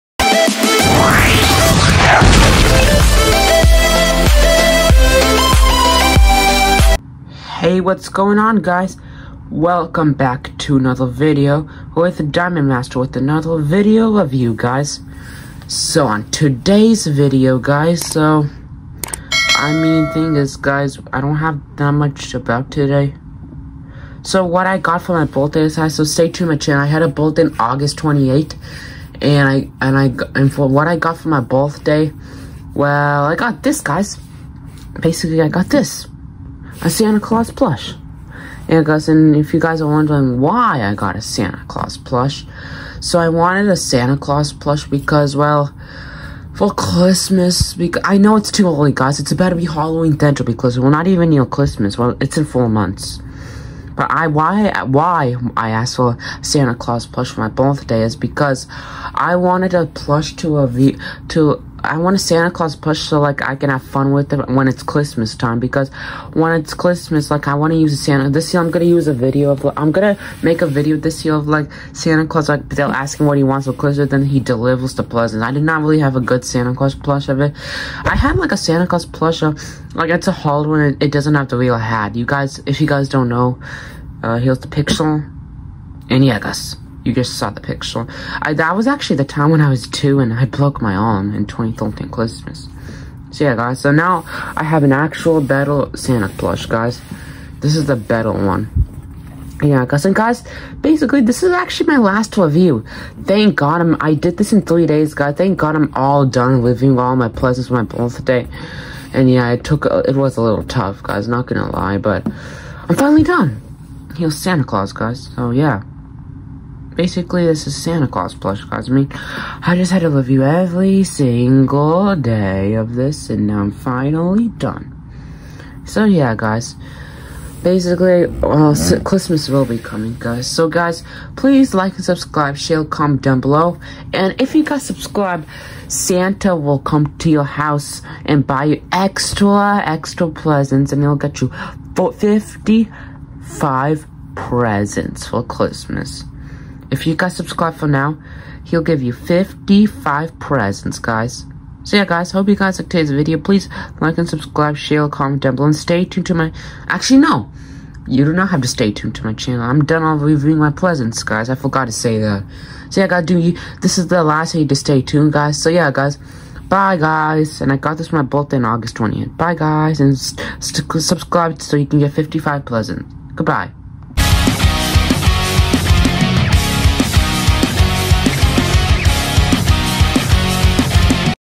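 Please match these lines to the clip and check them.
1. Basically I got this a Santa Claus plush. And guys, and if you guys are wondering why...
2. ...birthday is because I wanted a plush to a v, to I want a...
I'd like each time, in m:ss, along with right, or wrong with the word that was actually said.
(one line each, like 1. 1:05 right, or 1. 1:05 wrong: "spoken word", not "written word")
1. 0:34 right
2. 0:57 right.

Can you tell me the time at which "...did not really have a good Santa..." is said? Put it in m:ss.
1:15.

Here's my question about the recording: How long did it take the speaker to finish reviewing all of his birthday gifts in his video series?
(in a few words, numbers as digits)
3 days.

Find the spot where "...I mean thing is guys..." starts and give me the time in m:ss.
0:19.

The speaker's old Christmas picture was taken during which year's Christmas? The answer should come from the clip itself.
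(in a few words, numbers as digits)
2013.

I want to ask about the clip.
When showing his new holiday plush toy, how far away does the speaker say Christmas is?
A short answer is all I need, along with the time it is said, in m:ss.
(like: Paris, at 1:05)
4 months, at 0:52.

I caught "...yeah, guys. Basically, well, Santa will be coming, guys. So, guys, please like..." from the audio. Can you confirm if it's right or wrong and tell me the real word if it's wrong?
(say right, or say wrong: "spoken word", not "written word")
wrong: "Christmas", not "Santa".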